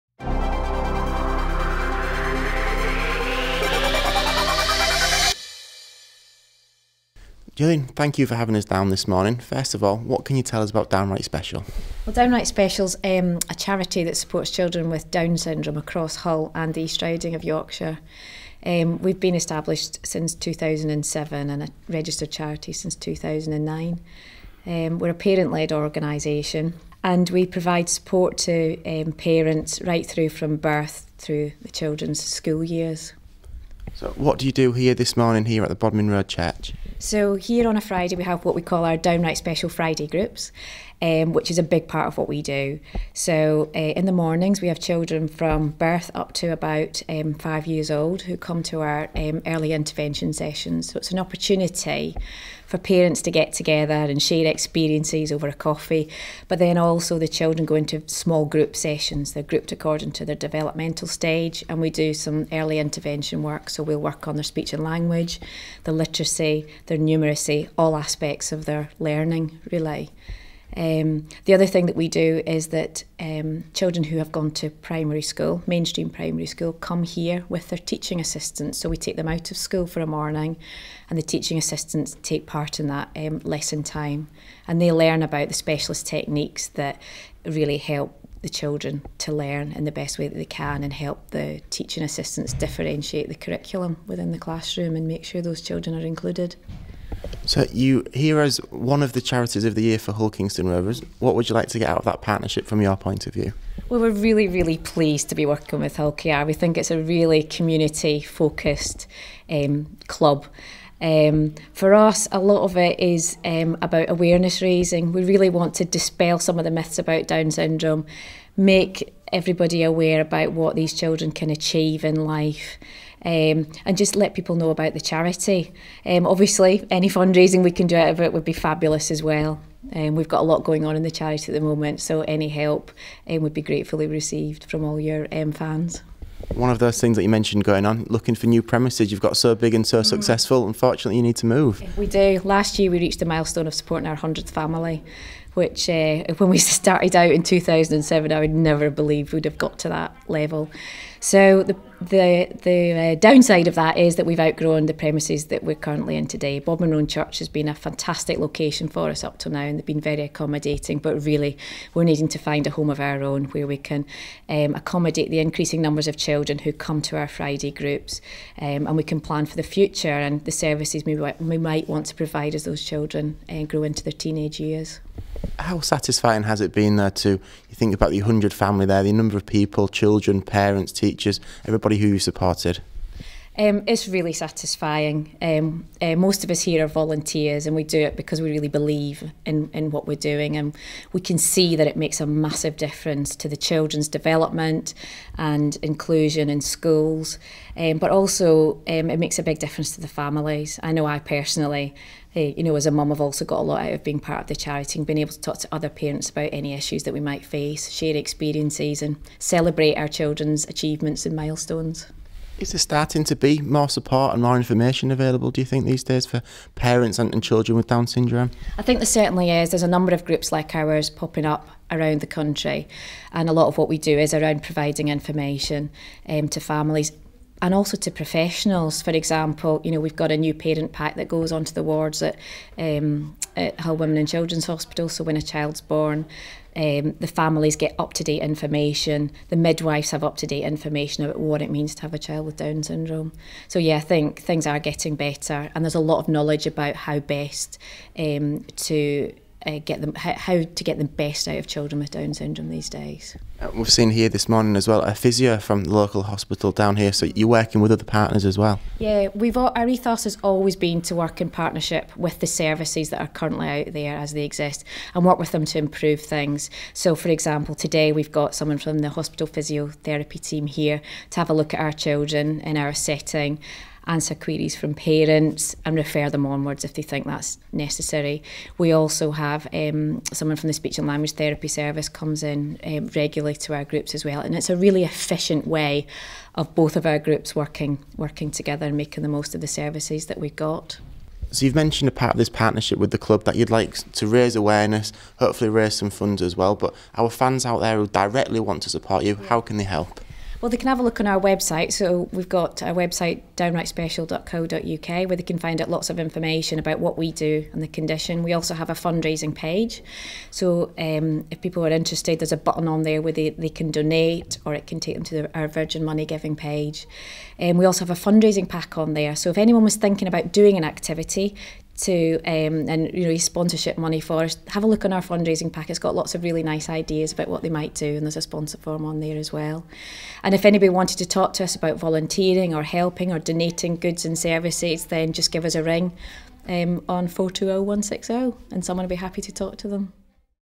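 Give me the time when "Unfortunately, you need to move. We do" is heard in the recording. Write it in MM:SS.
02:20.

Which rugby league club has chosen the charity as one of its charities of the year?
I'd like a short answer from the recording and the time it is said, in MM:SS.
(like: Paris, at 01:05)
Hull Kingston Rovers, at 01:40.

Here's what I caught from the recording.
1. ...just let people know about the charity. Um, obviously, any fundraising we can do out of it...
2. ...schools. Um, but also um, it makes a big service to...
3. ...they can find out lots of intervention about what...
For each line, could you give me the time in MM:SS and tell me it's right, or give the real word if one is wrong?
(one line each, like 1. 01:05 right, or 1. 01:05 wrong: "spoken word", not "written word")
1. 02:03 right
2. 03:16 wrong: "difference", not "service"
3. 05:05 wrong: "information", not "intervention".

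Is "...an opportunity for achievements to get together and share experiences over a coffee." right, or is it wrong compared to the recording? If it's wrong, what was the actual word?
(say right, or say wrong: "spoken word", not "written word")
wrong: "parents", not "achievements".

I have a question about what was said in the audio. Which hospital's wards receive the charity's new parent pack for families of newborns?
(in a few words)
Hull Women and Children's Hospital.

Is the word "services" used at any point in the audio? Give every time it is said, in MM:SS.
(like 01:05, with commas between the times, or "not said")
02:50, 04:22, 04:41, 04:49, 05:34.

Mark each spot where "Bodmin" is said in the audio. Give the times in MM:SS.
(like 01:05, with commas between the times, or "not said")
00:35, 02:36.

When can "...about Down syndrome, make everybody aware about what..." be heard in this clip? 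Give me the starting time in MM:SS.
01:56.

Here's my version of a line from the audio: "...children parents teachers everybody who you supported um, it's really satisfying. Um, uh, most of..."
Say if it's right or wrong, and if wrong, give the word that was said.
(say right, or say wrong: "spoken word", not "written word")
right.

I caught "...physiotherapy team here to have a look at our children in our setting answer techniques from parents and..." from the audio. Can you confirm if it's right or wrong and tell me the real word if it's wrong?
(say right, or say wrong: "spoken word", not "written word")
wrong: "queries", not "techniques".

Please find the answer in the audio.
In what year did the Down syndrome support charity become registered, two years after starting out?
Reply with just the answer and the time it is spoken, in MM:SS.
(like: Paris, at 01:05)
2009, at 00:22.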